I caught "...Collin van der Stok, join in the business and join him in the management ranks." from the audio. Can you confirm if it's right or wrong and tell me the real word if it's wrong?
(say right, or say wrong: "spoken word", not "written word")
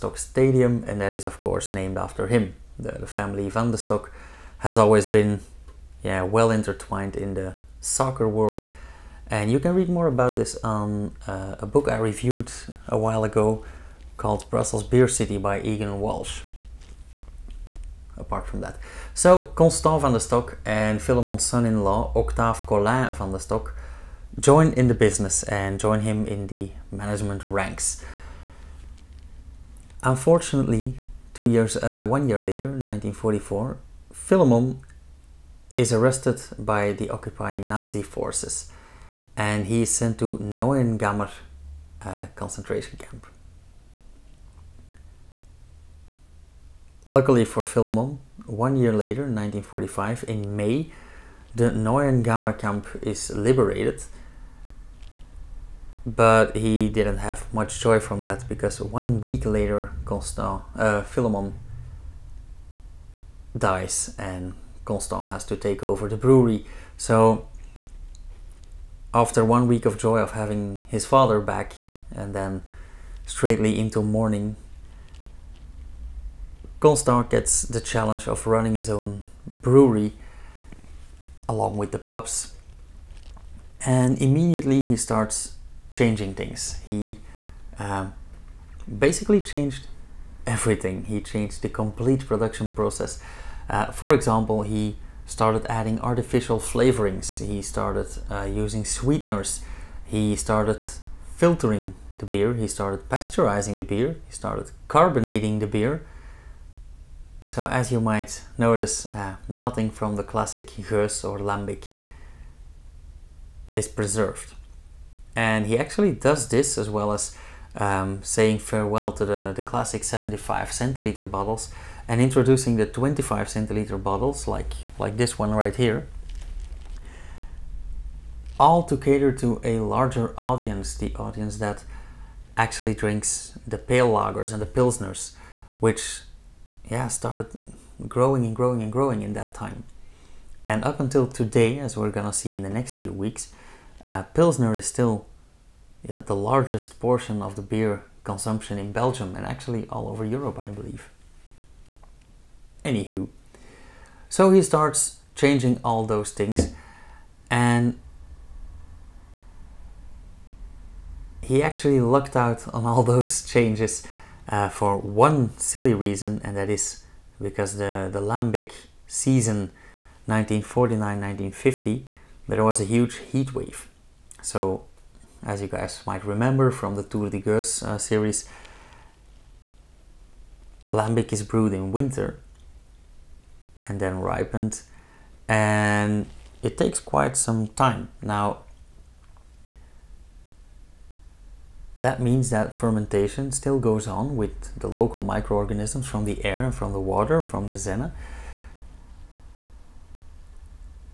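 right.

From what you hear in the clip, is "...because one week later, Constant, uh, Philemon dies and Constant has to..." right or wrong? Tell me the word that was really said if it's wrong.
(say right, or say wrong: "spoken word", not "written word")
right.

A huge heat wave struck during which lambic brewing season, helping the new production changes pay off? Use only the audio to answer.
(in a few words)
1949-1950.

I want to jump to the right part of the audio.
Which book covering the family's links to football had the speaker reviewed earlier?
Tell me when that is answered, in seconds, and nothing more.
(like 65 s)
14 s.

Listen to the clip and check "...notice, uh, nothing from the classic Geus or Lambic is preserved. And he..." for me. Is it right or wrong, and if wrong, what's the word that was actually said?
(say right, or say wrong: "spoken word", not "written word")
right.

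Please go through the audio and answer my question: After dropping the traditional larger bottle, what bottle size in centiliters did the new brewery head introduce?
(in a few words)
25 centiliters.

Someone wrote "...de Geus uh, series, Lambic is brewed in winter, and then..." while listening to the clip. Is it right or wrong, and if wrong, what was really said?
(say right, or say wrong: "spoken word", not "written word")
right.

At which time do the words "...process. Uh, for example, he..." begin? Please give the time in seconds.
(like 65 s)
92 s.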